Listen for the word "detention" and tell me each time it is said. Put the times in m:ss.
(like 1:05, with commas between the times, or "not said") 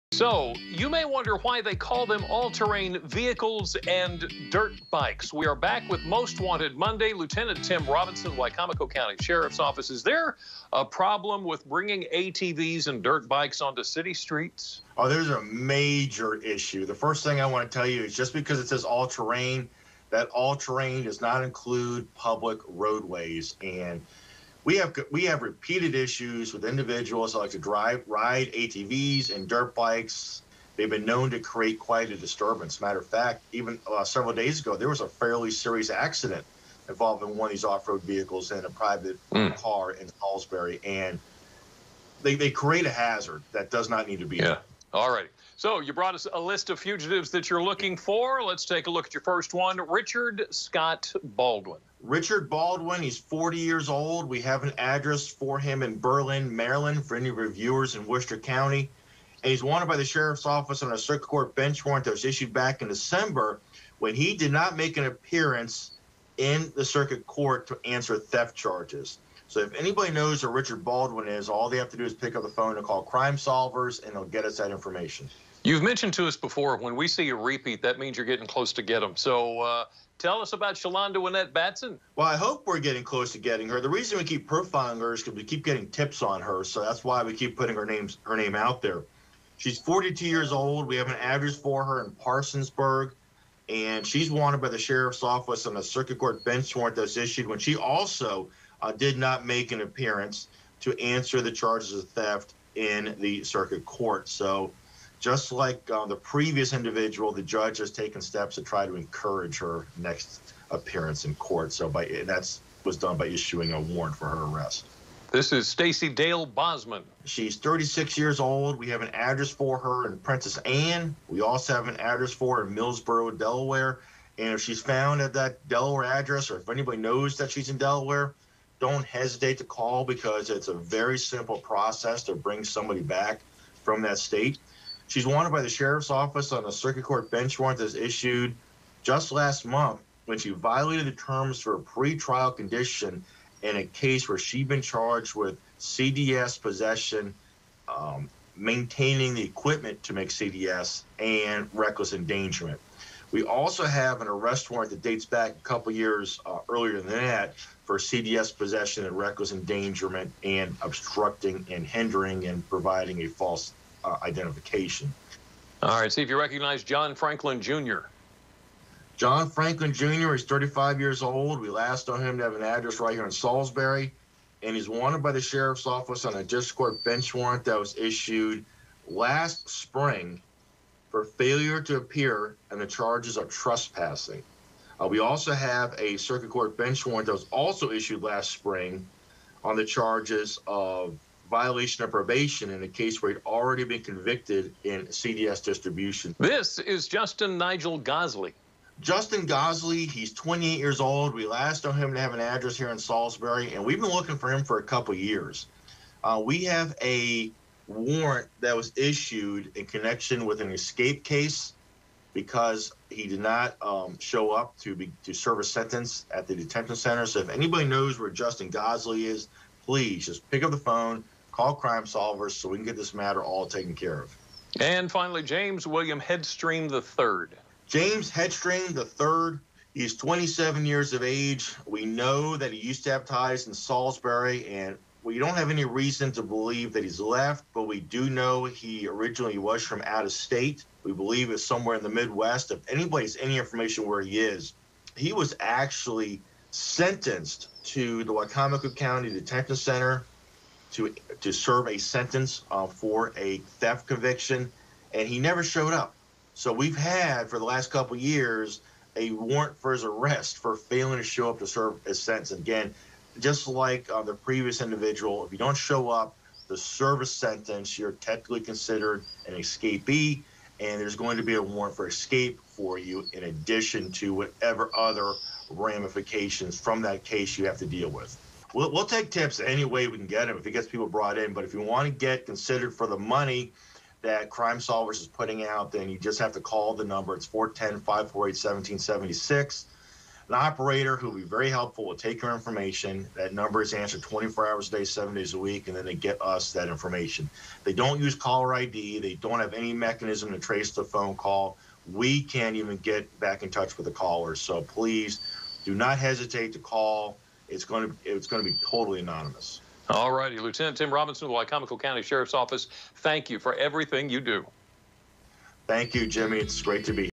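3:36, 4:09.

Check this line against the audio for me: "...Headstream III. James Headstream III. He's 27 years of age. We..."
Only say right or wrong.
right.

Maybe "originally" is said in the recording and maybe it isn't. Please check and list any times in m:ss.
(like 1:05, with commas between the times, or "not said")
3:59.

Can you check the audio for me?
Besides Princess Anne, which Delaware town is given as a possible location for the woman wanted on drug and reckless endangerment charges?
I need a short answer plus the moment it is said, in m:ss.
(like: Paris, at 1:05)
Millsboro, at 2:02.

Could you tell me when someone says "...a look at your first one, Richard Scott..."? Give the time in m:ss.
0:48.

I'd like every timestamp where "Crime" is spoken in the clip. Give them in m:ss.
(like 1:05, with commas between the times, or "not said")
1:13, 3:41, 4:44.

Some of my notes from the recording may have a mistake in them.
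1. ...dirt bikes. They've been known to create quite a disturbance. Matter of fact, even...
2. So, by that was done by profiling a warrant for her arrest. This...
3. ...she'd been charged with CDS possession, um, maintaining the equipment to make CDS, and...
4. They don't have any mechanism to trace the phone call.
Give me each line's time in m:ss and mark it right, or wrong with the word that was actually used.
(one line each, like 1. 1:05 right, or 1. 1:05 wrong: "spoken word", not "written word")
1. 0:29 right
2. 1:51 wrong: "issuing", not "profiling"
3. 2:24 right
4. 4:59 right.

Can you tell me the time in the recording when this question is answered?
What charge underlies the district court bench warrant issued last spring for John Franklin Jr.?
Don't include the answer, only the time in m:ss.
3:03.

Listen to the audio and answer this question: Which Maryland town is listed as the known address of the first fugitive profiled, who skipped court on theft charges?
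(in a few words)
Berlin.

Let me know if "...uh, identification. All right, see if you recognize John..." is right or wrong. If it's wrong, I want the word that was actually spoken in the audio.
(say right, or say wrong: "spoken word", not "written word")
right.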